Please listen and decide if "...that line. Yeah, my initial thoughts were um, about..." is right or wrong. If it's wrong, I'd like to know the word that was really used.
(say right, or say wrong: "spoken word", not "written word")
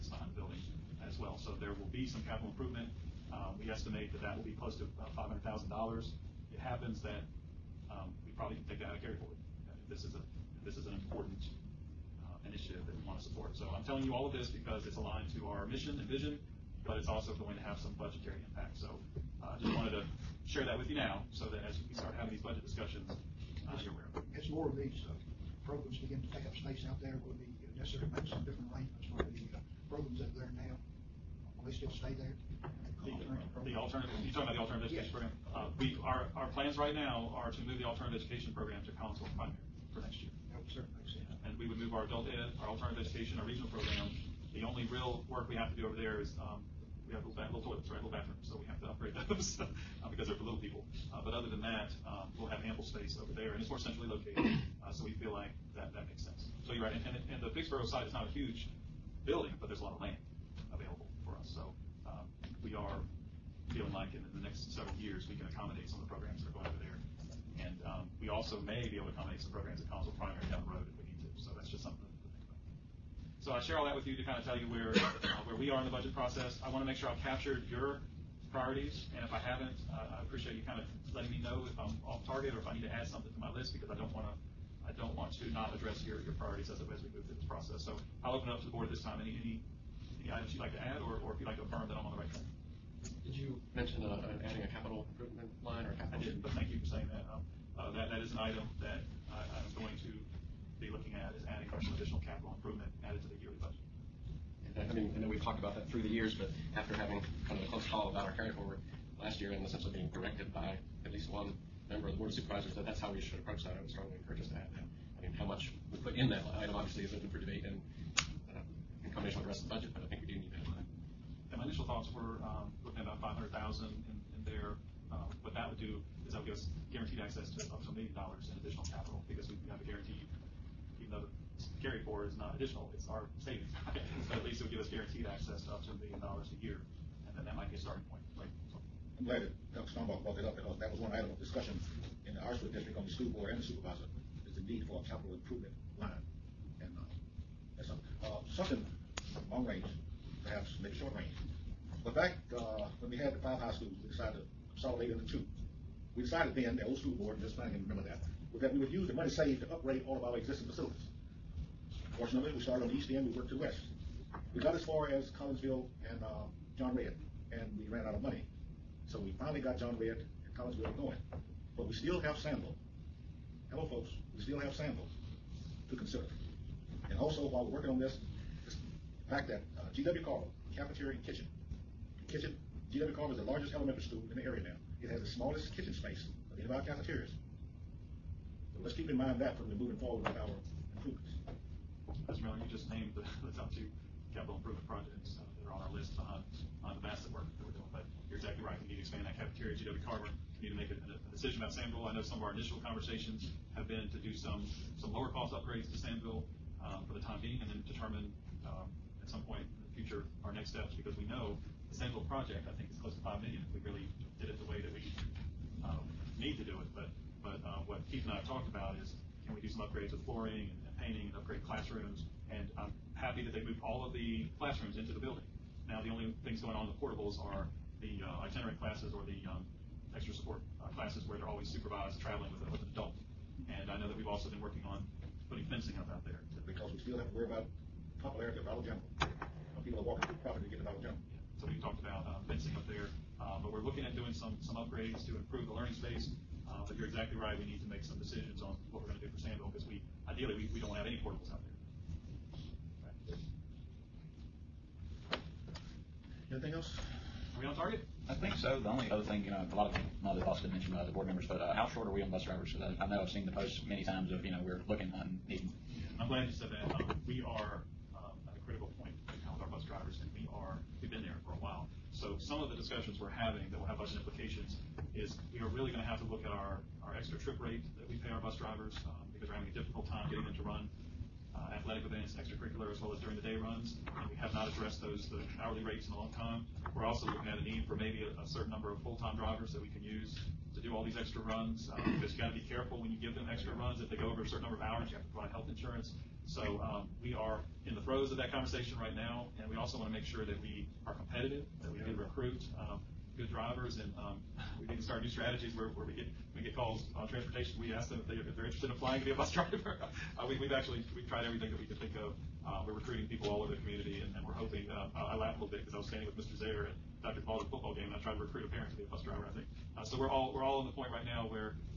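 right.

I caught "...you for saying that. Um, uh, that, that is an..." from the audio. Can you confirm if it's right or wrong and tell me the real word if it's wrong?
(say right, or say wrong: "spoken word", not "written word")
right.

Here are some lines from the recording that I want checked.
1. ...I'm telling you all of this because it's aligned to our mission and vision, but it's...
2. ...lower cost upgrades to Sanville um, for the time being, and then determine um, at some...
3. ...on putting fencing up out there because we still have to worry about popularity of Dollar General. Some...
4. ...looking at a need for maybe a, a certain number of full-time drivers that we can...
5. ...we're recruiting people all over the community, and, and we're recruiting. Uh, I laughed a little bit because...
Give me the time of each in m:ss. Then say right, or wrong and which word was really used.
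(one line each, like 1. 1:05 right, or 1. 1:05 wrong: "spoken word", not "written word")
1. 0:13 right
2. 3:25 right
3. 3:54 right
4. 4:47 right
5. 5:12 wrong: "hoping", not "recruiting".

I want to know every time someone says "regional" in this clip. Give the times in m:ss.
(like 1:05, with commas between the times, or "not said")
0:43.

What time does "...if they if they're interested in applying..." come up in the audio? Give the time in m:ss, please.
5:08.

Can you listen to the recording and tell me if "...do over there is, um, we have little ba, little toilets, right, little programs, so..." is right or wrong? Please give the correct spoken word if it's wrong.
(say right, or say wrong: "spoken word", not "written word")
wrong: "bathrooms", not "programs".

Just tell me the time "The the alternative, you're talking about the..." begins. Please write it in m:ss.
0:33.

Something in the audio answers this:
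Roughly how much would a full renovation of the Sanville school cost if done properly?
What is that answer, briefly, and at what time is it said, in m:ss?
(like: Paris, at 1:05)
$5 million, at 3:33.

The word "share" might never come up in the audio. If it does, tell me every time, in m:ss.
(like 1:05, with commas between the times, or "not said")
0:20, 1:13.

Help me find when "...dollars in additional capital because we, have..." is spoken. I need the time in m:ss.
2:08.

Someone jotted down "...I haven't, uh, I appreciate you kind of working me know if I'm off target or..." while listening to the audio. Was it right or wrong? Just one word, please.
wrong.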